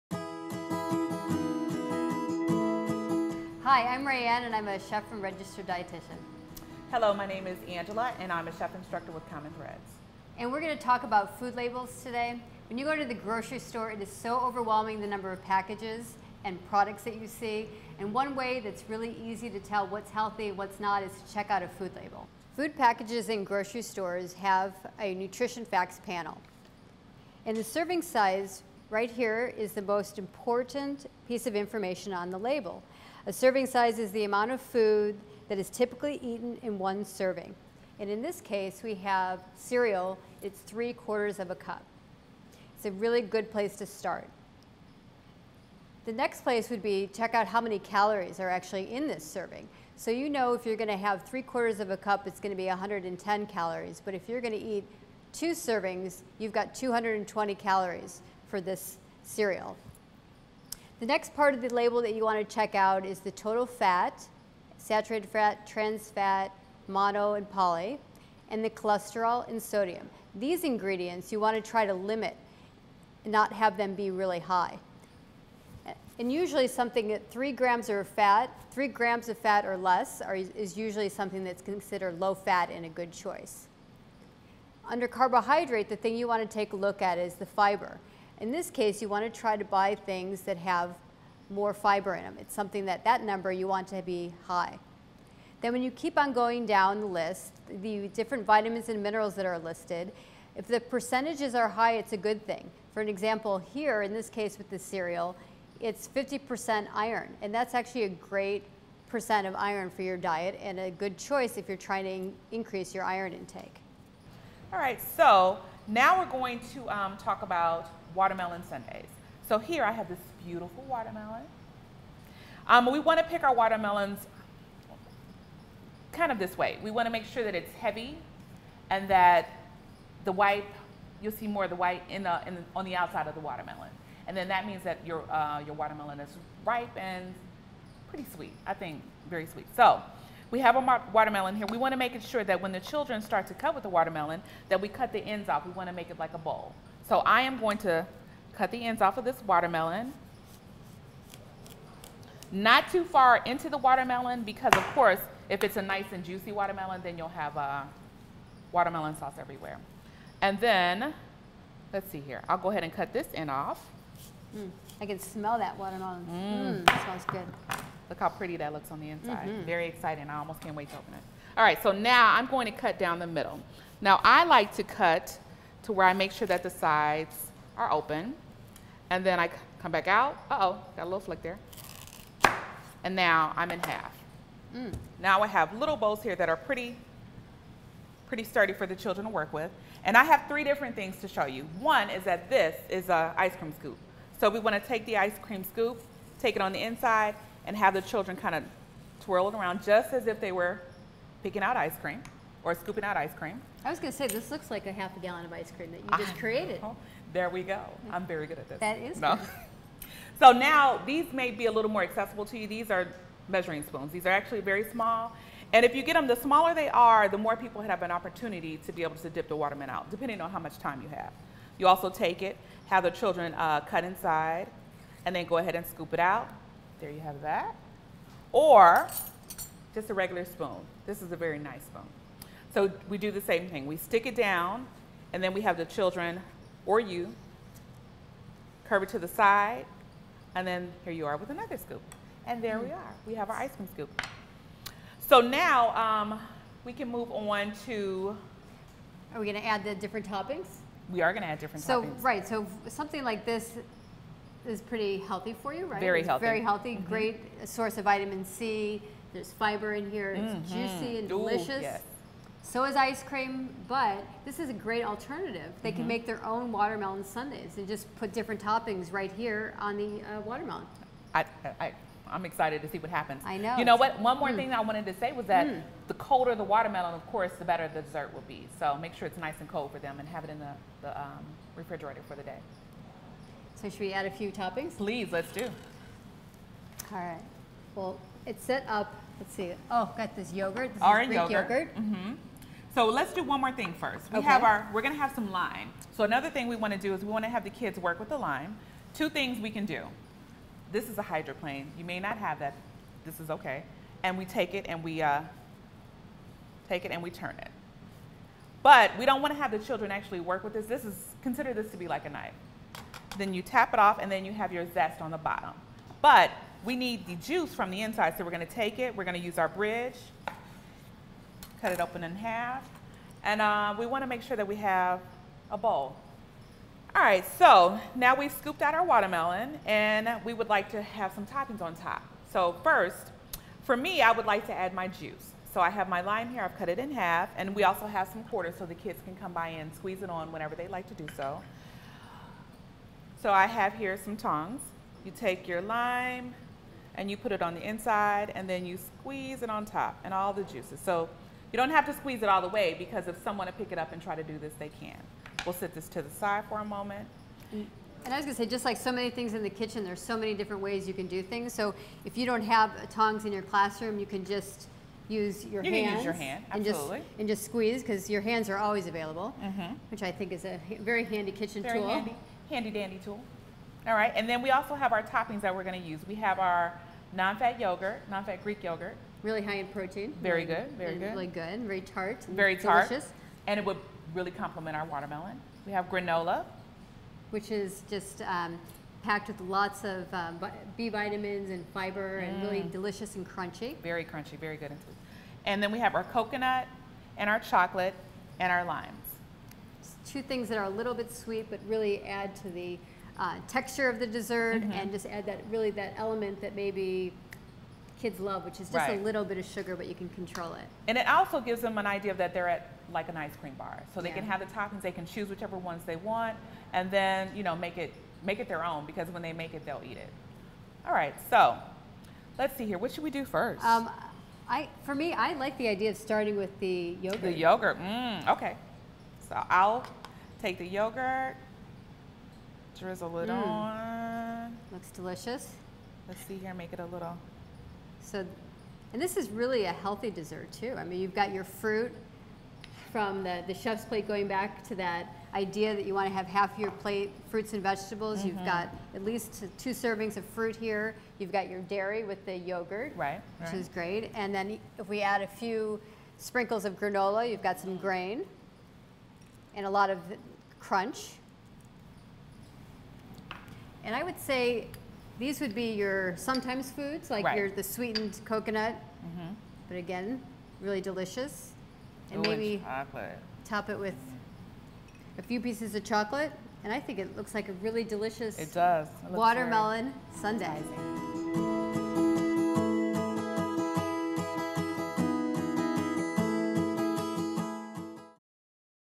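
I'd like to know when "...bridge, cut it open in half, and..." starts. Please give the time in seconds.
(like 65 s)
319 s.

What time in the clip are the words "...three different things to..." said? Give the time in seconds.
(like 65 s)
190 s.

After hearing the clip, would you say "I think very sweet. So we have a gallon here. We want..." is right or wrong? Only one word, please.
wrong.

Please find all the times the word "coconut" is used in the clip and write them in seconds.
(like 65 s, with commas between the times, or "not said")
396 s, 468 s.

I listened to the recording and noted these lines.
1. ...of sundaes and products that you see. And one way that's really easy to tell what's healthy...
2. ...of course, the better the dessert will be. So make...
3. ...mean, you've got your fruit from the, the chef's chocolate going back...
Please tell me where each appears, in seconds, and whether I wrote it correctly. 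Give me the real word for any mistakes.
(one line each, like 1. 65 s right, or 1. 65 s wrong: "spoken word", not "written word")
1. 15 s wrong: "packages", not "sundaes"
2. 277 s right
3. 441 s wrong: "plate", not "chocolate".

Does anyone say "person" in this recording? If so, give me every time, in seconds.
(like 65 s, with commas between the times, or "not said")
not said.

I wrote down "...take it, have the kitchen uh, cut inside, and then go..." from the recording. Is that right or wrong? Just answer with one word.
wrong.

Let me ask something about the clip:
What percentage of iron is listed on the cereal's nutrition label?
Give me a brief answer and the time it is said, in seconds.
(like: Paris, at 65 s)
50%, at 106 s.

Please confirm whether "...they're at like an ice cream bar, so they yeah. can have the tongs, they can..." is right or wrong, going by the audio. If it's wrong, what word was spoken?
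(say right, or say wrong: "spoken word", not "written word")
wrong: "toppings", not "tongs".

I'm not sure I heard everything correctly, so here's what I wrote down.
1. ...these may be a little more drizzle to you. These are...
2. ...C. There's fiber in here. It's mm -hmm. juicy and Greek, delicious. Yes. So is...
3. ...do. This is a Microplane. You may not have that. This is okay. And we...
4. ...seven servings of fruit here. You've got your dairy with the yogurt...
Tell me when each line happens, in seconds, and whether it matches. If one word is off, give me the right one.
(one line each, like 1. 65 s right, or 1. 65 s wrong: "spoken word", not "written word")
1. 211 s wrong: "accessible", not "drizzle"
2. 258 s wrong: "Ooh", not "Greek"
3. 299 s right
4. 449 s wrong: "two", not "seven".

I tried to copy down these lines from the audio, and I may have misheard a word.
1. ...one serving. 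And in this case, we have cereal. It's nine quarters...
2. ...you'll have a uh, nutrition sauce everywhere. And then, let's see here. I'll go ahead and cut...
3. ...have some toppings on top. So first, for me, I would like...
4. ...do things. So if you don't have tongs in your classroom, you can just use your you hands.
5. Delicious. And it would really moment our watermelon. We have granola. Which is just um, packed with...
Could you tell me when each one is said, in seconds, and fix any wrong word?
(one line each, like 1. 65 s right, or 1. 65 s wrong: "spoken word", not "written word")
1. 36 s wrong: "three", not "nine"
2. 157 s wrong: "watermelon", not "nutrition"
3. 331 s right
4. 361 s right
5. 383 s wrong: "complement", not "moment".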